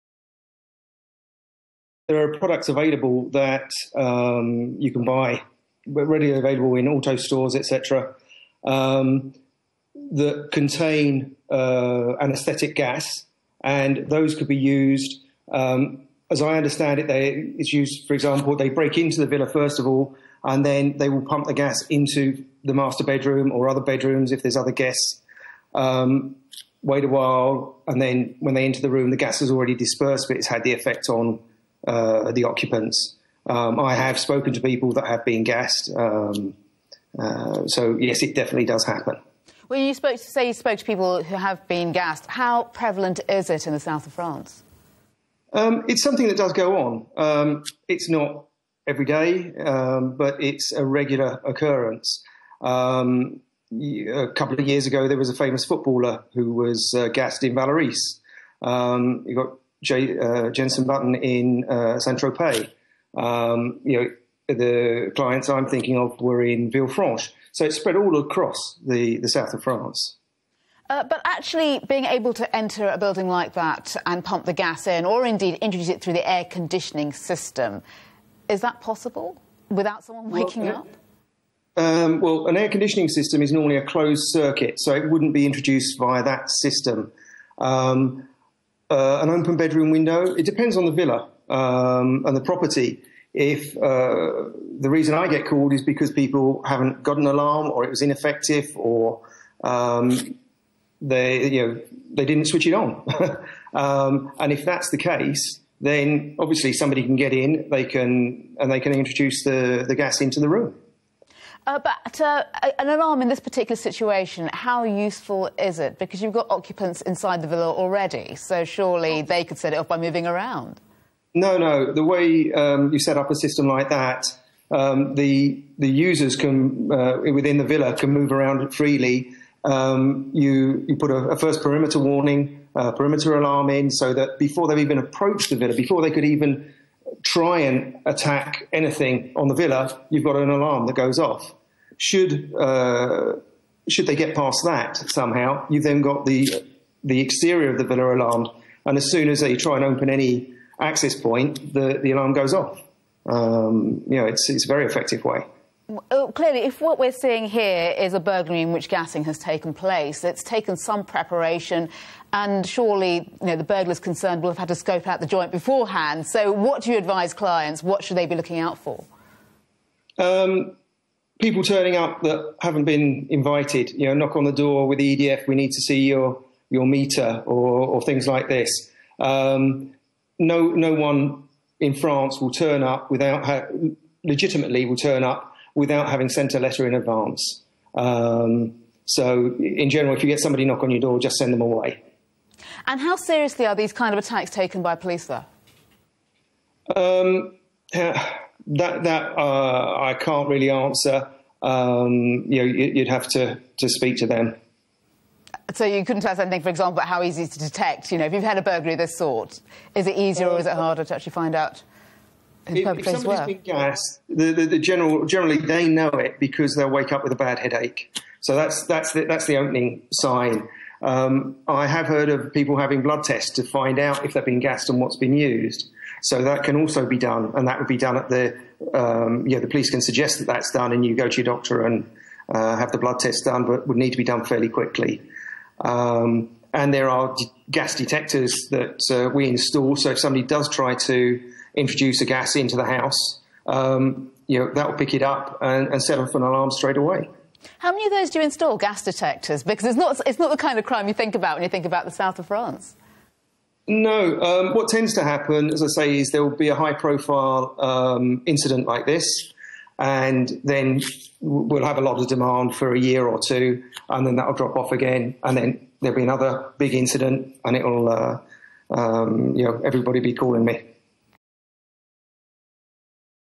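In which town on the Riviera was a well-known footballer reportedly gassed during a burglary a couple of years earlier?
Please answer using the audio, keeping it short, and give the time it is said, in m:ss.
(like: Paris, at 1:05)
Vallauris, at 0:57.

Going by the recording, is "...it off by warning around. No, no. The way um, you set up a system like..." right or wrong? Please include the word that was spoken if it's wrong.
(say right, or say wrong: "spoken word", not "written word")
wrong: "moving", not "warning".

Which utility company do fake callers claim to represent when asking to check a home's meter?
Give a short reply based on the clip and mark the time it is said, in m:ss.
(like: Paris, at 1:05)
EDF, at 2:55.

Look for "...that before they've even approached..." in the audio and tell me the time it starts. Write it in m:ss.
2:14.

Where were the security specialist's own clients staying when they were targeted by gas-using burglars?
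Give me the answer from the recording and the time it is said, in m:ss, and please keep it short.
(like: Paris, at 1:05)
Villefranche, at 1:06.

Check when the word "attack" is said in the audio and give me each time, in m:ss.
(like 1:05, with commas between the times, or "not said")
2:18, 3:14.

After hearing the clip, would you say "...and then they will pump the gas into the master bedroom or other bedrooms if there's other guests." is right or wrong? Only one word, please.
right.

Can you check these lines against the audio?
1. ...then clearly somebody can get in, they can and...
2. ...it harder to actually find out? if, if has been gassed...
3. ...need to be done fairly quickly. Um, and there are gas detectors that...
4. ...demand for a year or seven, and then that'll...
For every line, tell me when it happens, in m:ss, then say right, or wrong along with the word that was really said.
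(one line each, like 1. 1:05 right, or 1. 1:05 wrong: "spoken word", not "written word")
1. 1:45 wrong: "obviously", not "clearly"
2. 3:30 right
3. 3:53 right
4. 4:22 wrong: "two", not "seven".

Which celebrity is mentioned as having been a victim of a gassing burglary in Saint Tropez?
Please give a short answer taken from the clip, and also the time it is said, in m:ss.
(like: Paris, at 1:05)
Jensen Button, at 1:00.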